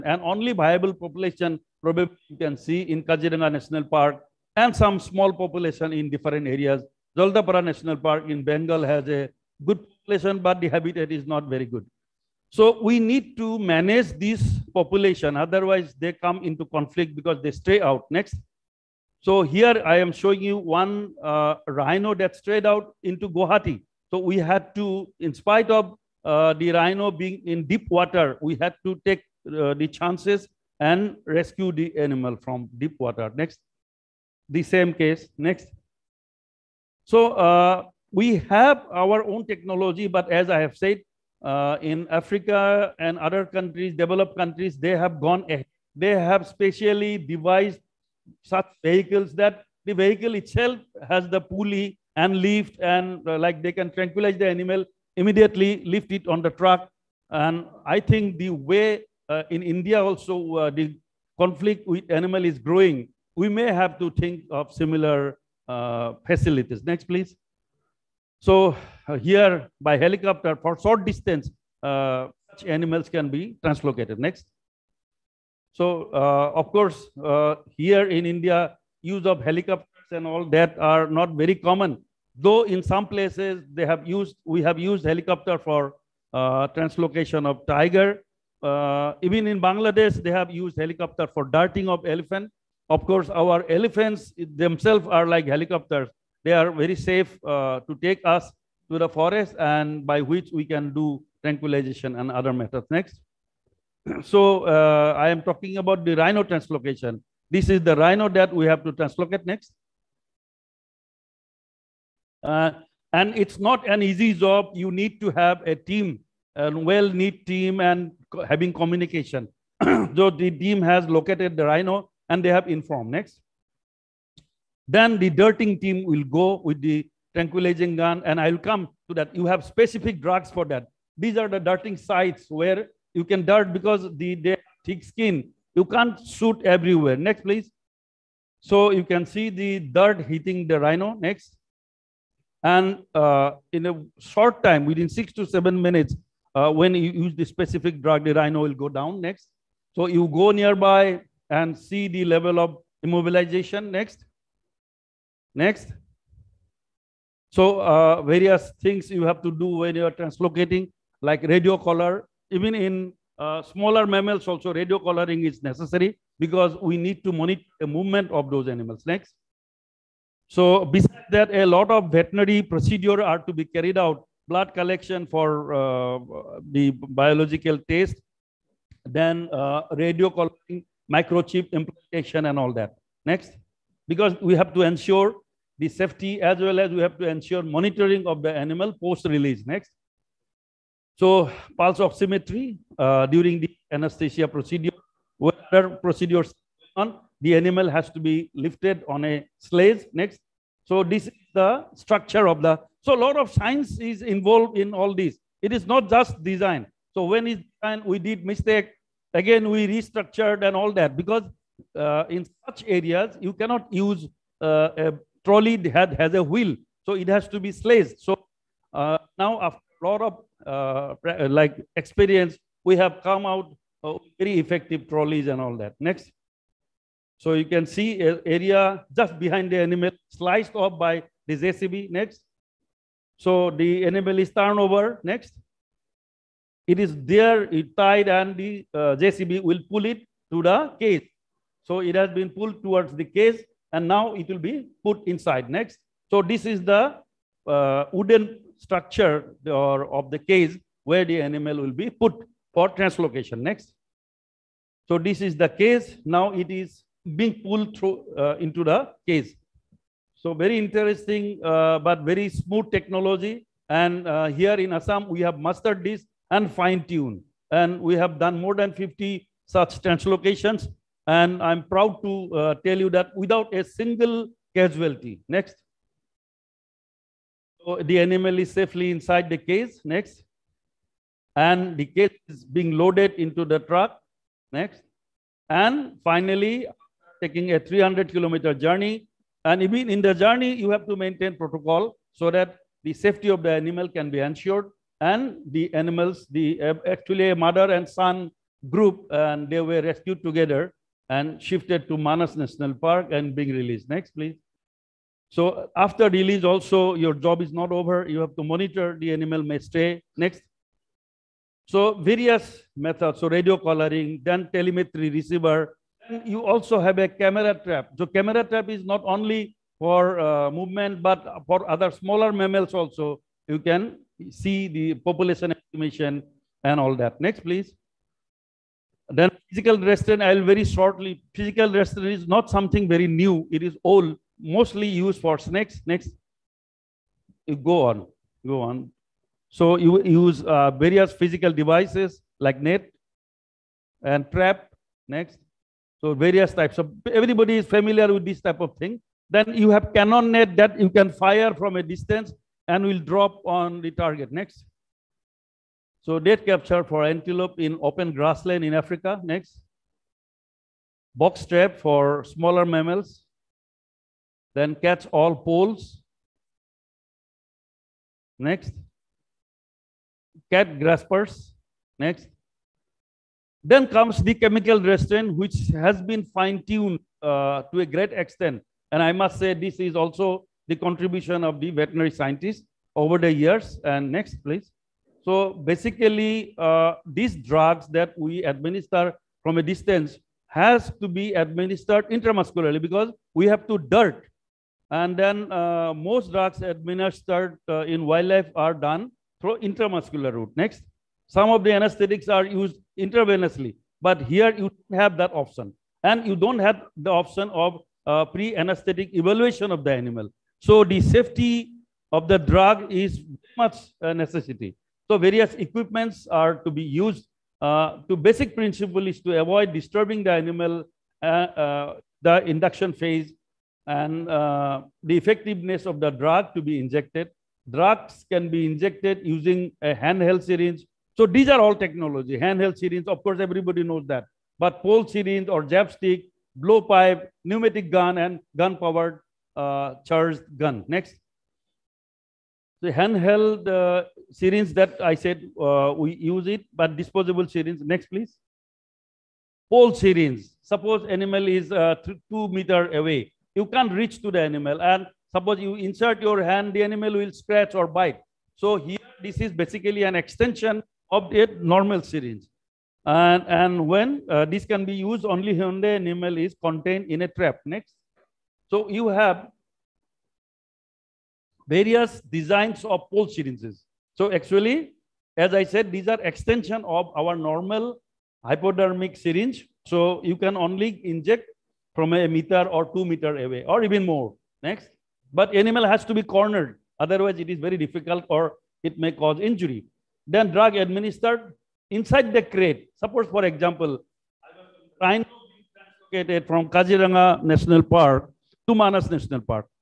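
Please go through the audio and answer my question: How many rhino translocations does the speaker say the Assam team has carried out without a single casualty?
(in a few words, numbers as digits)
More than 50.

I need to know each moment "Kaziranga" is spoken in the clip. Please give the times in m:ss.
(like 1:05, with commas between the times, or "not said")
0:03, 8:16.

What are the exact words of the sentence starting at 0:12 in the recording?
So we need to manage this population, otherwise they come into conflict because they stray out.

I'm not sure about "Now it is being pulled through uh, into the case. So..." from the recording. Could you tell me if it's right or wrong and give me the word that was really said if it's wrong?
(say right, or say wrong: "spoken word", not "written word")
right.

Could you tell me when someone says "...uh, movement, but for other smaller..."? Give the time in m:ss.
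5:20.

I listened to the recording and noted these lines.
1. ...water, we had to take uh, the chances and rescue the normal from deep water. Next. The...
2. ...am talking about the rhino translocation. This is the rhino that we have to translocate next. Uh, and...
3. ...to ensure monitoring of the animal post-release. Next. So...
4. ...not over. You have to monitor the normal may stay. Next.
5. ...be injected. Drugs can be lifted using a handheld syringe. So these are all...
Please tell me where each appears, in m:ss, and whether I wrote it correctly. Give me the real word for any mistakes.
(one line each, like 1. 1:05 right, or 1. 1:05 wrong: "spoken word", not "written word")
1. 0:27 wrong: "animal", not "normal"
2. 1:45 right
3. 3:07 right
4. 5:07 wrong: "animal", not "normal"
5. 7:06 wrong: "injected", not "lifted".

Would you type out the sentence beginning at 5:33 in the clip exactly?
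It is old, mostly used for snakes.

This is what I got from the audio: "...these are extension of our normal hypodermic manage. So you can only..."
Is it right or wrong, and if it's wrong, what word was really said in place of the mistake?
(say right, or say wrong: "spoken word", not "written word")
wrong: "syringe", not "manage".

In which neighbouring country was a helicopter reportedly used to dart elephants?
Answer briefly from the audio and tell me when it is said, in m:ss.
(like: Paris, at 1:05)
Bangladesh, at 1:29.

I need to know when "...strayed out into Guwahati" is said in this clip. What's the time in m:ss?
0:22.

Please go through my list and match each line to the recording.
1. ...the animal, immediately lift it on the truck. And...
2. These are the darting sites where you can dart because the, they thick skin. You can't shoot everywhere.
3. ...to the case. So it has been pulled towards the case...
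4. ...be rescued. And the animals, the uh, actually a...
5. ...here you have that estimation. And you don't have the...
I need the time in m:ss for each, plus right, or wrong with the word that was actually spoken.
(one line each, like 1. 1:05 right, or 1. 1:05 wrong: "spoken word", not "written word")
1. 0:54 right
2. 2:11 right
3. 4:00 right
4. 4:54 wrong: "ensured", not "rescued"
5. 6:44 wrong: "option", not "estimation".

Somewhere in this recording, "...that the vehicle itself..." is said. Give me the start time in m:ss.
0:49.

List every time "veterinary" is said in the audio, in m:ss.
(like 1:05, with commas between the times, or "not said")
2:52, 6:21.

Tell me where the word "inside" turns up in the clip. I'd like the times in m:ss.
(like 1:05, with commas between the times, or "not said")
4:05, 4:39, 8:12.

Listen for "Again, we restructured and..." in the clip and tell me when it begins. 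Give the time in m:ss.
3:29.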